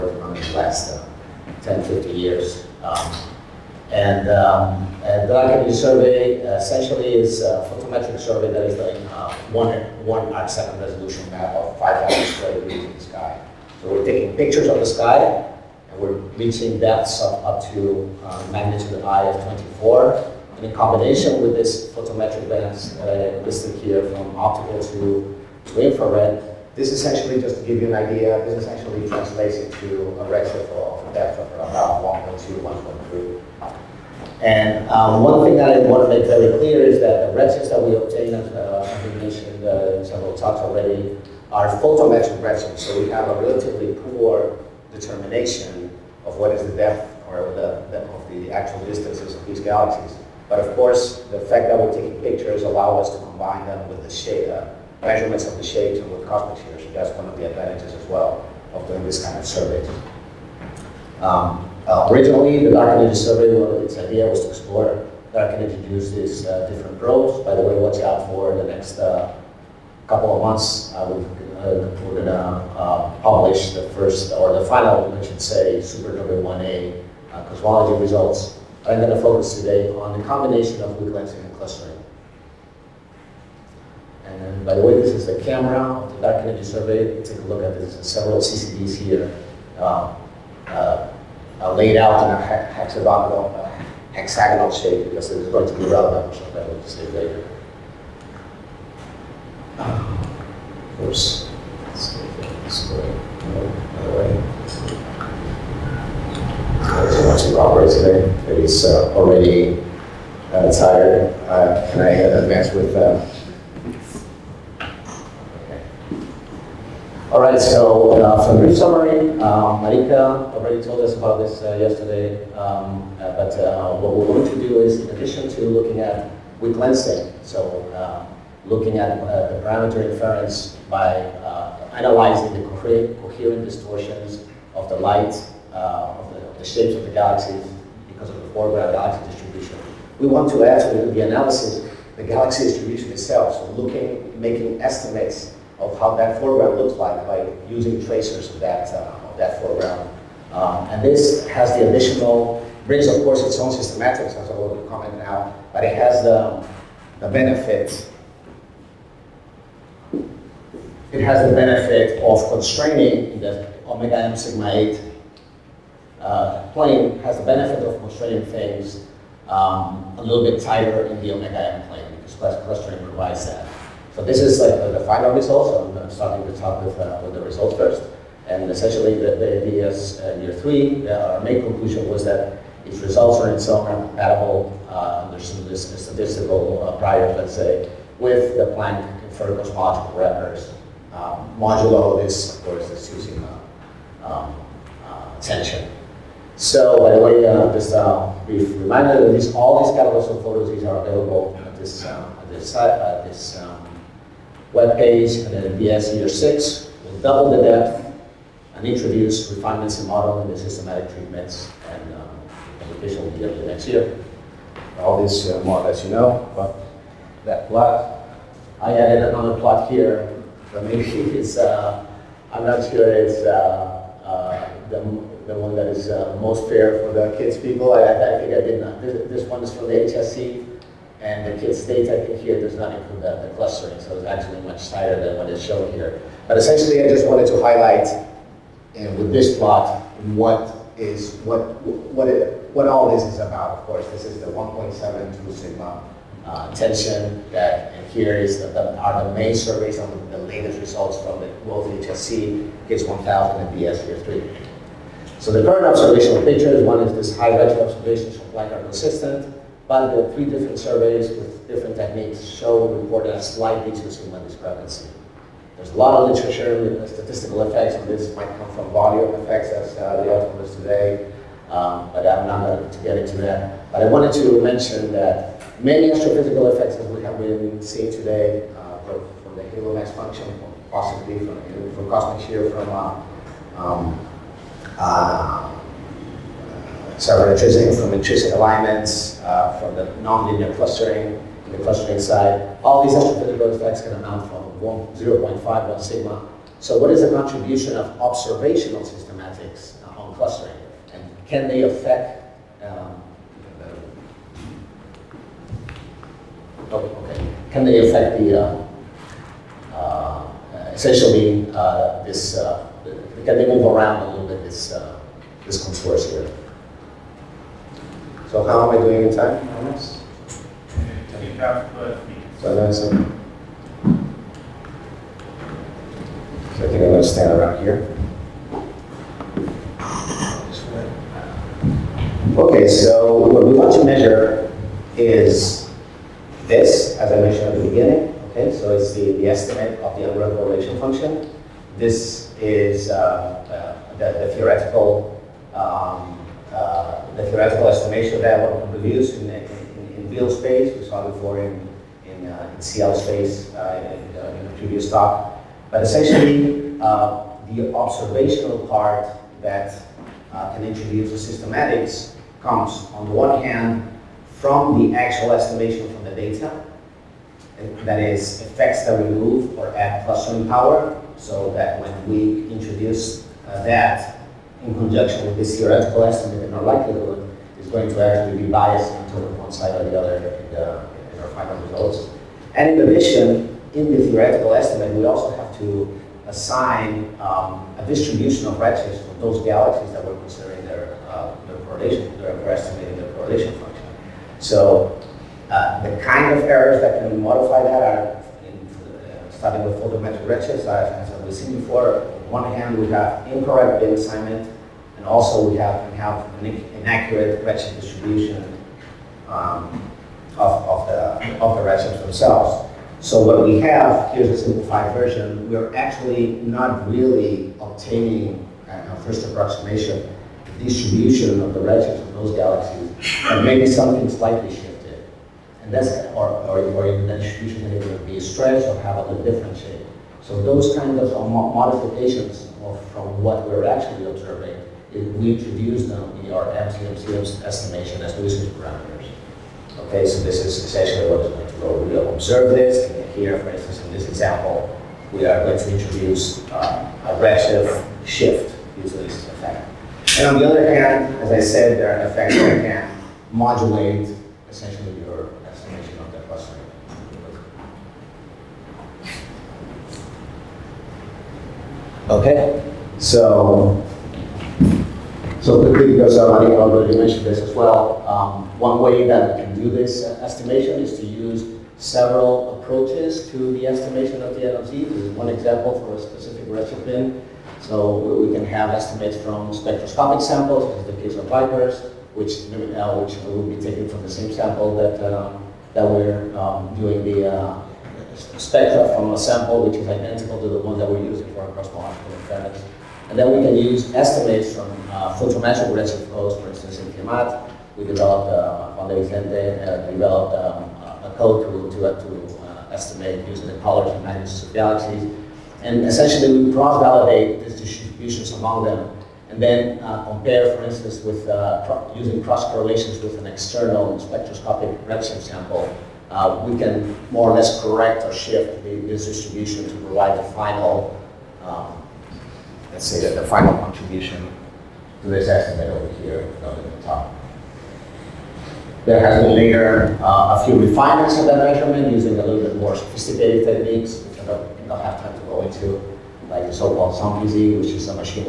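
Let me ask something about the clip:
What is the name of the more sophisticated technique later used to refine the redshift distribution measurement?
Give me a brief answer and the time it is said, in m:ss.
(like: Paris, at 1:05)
SOMPZ, at 8:57.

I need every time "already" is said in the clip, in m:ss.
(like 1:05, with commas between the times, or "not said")
0:40, 1:49, 2:00, 7:46.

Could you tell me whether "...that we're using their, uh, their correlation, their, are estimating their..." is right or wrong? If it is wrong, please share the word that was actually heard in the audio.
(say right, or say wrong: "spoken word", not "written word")
wrong: "considering", not "using".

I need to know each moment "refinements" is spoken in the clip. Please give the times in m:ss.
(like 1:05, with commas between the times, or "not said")
3:29, 8:50.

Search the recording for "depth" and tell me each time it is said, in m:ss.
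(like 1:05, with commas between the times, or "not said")
0:16, 0:31, 0:46, 3:27.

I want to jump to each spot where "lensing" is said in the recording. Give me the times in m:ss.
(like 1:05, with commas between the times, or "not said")
1:21, 2:06.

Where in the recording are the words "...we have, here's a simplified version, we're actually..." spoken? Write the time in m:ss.
6:53.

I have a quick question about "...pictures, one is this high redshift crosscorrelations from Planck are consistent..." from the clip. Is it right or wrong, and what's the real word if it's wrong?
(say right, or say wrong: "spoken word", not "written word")
wrong: "observations", not "crosscorrelations".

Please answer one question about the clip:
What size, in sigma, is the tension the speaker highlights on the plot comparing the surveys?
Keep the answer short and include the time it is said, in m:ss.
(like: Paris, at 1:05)
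1.72 sigma, at 4:04.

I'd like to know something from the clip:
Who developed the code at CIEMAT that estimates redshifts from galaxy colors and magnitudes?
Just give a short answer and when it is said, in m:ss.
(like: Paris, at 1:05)
Juan de Vicente, at 8:18.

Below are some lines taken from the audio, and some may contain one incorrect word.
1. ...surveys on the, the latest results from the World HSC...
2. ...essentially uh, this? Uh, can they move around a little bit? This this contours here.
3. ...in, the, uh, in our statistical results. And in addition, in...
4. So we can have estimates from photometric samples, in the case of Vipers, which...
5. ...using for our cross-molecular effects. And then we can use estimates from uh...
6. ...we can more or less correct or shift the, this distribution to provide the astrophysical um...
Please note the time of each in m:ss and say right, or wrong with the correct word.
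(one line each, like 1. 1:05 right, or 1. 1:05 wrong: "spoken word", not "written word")
1. 4:09 right
2. 5:10 right
3. 6:20 wrong: "final", not "statistical"
4. 7:57 wrong: "spectroscopic", not "photometric"
5. 8:11 right
6. 8:36 wrong: "final", not "astrophysical".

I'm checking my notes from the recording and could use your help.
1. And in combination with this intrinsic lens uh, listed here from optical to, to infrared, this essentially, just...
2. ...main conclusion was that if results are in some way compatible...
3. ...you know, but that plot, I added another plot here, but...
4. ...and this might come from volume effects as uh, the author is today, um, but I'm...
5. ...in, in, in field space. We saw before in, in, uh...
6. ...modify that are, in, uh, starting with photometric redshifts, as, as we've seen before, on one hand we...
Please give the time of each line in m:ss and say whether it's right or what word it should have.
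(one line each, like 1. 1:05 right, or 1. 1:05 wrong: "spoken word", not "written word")
1. 0:20 wrong: "photometric", not "intrinsic"
2. 3:01 right
3. 3:36 right
4. 4:27 right
5. 5:49 right
6. 6:37 right.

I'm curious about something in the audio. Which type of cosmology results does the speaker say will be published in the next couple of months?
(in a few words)
Supernova 1A.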